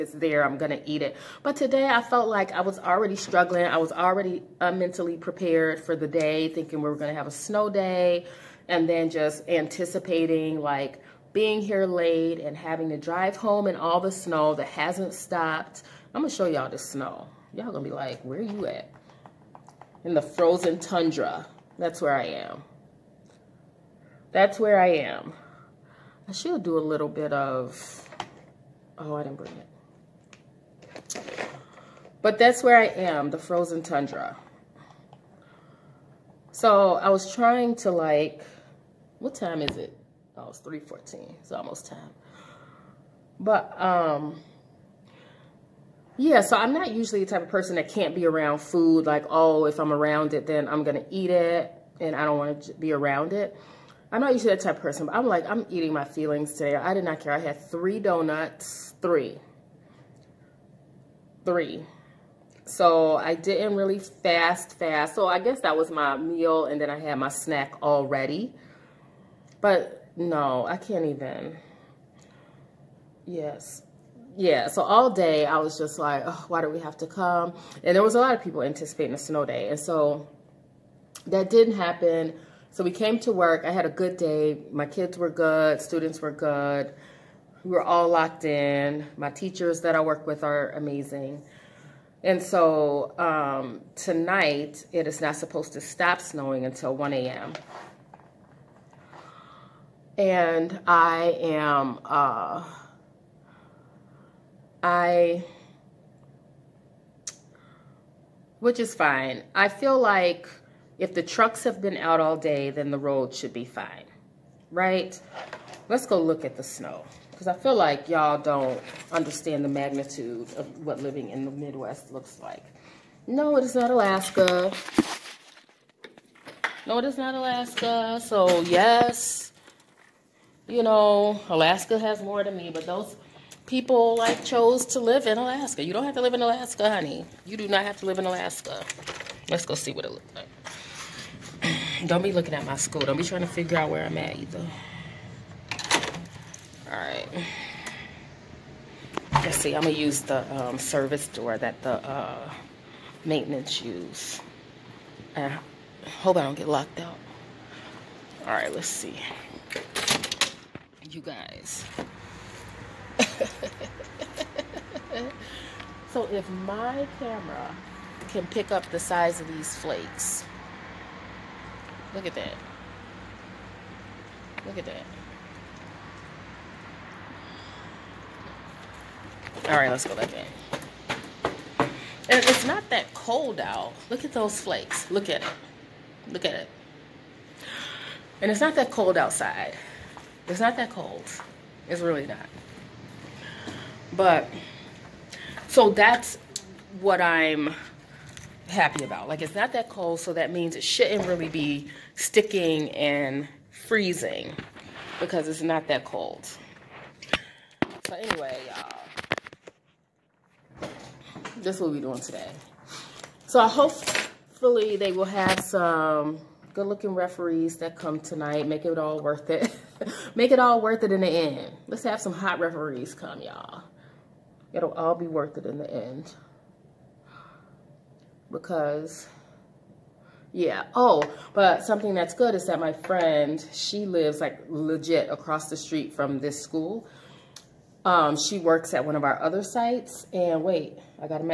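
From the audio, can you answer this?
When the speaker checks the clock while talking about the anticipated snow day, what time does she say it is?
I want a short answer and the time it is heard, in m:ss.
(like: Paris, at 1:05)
3:14, at 0:40.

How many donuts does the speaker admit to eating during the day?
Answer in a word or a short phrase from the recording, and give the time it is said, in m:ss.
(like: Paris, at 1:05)
3, at 0:57.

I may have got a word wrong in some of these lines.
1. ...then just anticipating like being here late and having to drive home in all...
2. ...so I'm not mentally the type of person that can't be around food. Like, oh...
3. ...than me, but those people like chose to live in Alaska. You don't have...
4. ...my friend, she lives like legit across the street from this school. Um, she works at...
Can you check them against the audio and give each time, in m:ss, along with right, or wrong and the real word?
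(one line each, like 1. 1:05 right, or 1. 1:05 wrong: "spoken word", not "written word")
1. 0:08 right
2. 0:46 wrong: "usually", not "mentally"
3. 2:12 right
4. 3:52 right.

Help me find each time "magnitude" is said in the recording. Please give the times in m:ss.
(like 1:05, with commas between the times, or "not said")
1:59.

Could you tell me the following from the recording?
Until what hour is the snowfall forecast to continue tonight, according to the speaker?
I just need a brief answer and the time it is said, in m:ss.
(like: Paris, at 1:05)
1 a.m., at 1:36.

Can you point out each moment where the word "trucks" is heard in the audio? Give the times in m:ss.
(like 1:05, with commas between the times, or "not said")
1:51.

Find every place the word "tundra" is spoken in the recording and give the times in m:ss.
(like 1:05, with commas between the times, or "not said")
0:20, 0:33.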